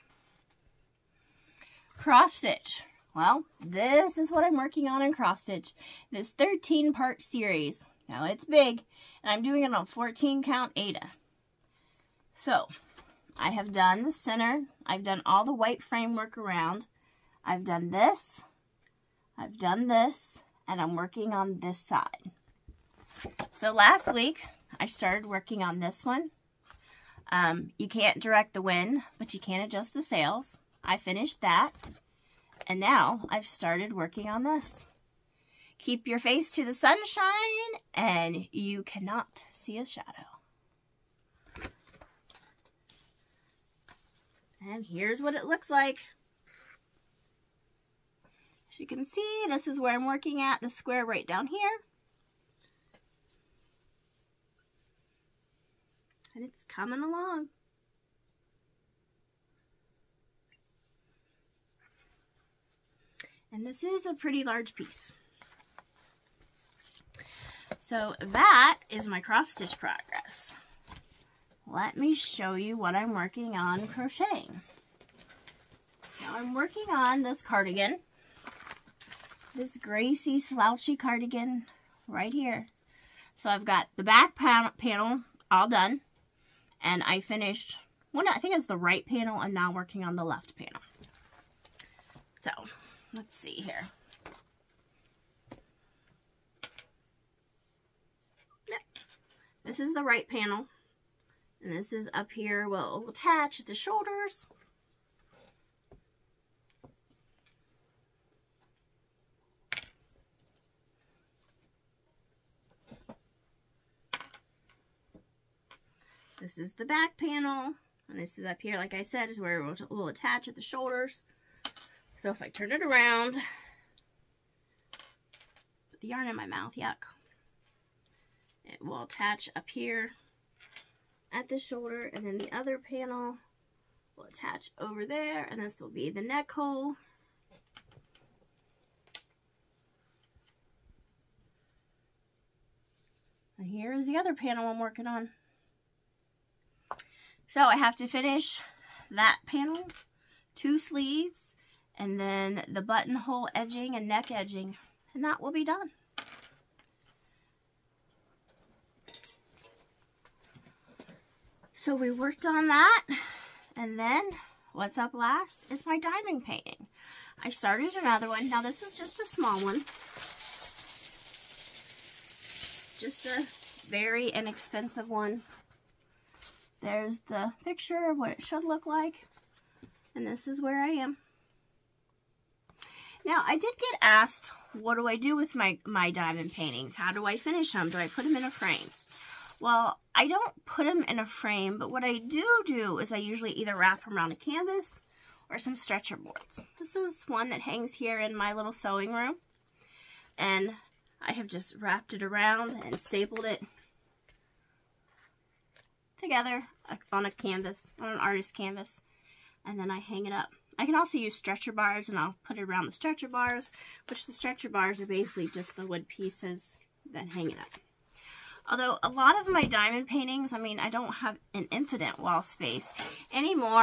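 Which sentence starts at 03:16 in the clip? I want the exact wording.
This is one that hangs here in my little sewing room.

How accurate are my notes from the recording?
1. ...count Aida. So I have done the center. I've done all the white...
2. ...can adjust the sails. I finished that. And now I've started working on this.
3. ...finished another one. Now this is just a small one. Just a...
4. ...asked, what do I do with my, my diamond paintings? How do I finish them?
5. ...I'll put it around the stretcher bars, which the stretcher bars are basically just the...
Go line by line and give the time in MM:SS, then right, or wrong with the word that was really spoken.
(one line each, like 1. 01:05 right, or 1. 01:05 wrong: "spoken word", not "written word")
1. 00:10 right
2. 00:29 right
3. 02:47 wrong: "started", not "finished"
4. 03:04 right
5. 03:32 right.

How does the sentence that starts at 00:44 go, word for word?
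And here's what it looks like.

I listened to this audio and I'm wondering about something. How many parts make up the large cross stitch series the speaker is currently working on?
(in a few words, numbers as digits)
13.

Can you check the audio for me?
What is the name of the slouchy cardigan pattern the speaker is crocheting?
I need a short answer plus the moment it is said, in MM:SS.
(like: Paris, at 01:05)
Gracie, at 01:19.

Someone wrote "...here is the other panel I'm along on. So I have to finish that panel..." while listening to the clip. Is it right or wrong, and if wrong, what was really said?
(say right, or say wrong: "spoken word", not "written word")
wrong: "working", not "along".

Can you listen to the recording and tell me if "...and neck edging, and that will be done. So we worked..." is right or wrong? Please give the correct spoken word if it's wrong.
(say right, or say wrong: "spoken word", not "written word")
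right.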